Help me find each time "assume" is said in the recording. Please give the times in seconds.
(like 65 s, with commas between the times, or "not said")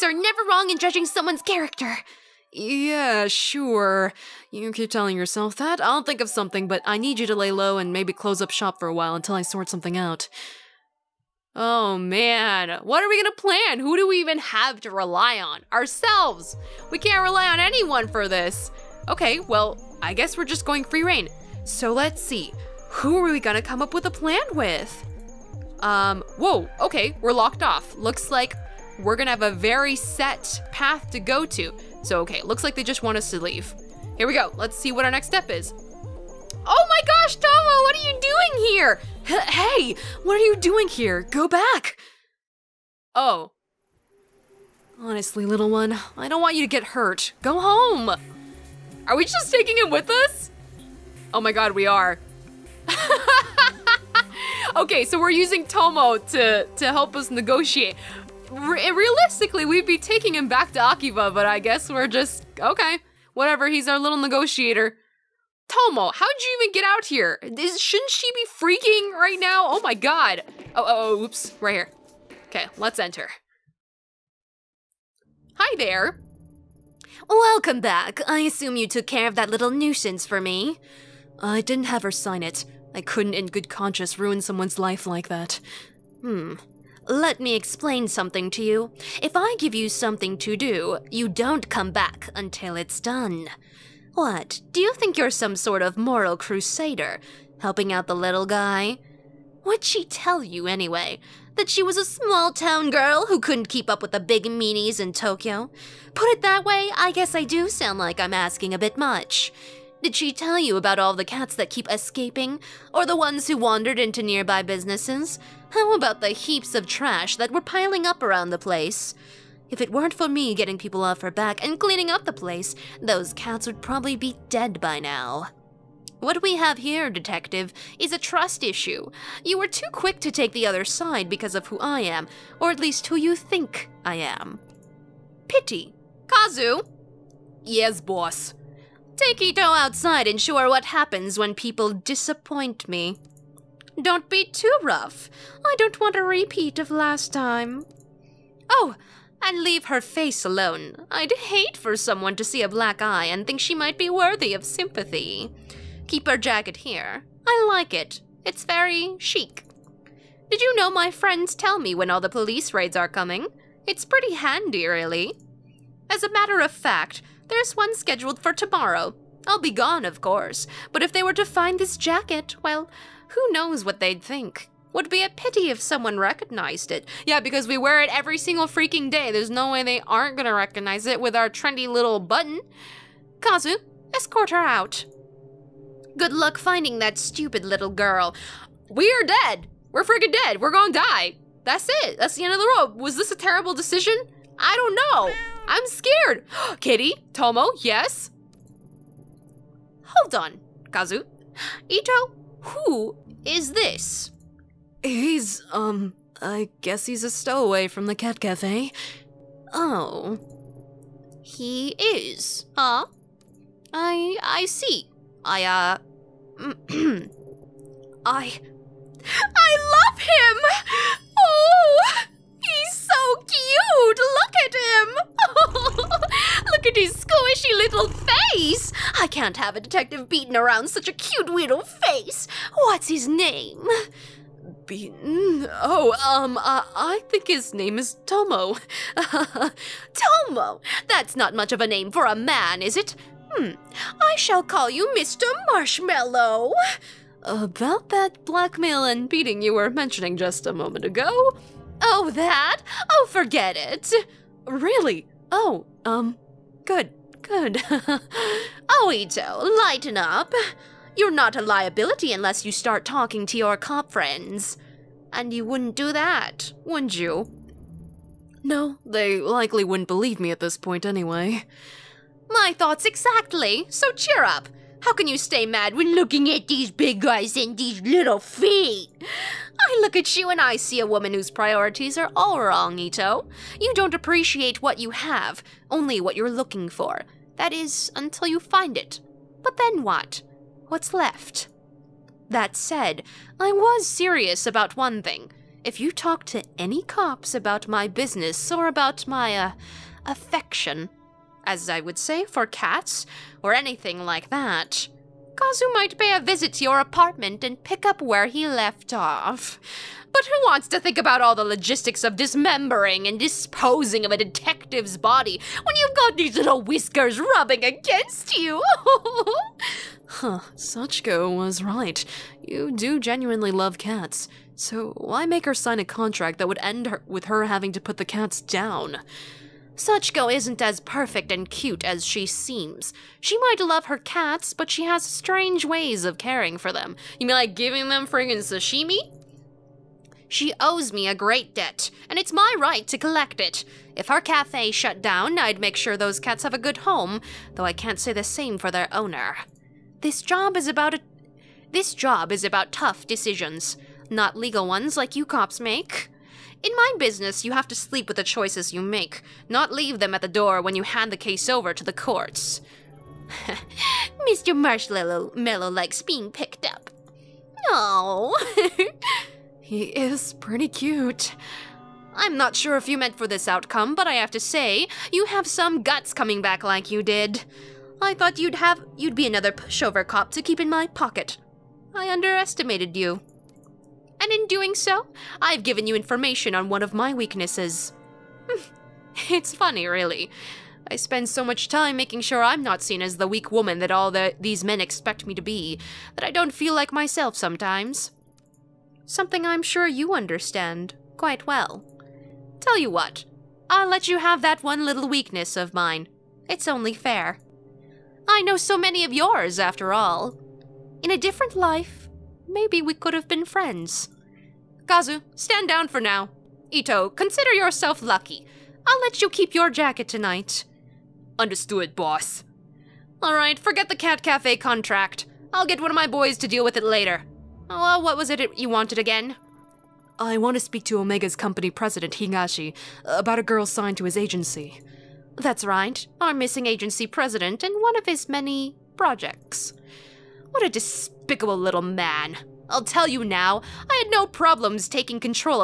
78 s.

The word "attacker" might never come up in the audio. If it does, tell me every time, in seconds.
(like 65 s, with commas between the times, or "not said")
not said.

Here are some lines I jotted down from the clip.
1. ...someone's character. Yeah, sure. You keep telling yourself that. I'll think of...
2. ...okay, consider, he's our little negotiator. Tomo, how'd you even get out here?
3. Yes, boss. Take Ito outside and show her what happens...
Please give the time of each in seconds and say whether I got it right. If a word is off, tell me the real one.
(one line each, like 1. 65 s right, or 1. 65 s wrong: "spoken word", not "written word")
1. 1 s right
2. 62 s wrong: "whatever", not "consider"
3. 137 s right.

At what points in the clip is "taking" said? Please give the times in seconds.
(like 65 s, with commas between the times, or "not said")
49 s, 59 s, 445 s.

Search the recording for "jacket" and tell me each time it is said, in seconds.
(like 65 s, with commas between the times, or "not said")
156 s, 171 s, 419 s.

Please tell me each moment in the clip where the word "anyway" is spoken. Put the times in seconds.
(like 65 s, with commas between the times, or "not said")
100 s, 271 s.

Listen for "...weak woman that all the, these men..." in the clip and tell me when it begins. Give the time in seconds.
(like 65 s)
393 s.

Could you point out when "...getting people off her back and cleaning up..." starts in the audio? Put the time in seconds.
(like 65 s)
120 s.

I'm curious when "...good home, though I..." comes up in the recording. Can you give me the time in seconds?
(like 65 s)
346 s.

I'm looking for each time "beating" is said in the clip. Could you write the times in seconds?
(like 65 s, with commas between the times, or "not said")
230 s, 249 s.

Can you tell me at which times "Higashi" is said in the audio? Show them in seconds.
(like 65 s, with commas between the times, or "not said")
432 s.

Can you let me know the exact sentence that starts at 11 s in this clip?
Oh man, what are we gonna plan?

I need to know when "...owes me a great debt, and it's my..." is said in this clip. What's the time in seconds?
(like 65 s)
340 s.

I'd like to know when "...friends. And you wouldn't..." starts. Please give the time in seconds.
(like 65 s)
264 s.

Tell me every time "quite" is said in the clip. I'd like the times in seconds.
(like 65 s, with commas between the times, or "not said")
401 s.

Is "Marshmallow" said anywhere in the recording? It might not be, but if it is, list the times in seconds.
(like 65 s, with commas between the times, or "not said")
245 s, 364 s.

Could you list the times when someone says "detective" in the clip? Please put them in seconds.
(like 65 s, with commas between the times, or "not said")
127 s, 229 s, 314 s.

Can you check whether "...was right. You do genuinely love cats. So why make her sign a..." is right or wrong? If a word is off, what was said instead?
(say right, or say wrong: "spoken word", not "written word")
right.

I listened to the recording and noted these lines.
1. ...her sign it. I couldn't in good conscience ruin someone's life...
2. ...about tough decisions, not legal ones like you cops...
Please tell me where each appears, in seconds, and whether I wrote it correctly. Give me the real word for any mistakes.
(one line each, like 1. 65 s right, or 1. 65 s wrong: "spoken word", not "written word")
1. 82 s right
2. 352 s right.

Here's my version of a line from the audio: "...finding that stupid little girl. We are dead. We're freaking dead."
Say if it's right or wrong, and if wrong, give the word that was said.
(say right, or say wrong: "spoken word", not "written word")
right.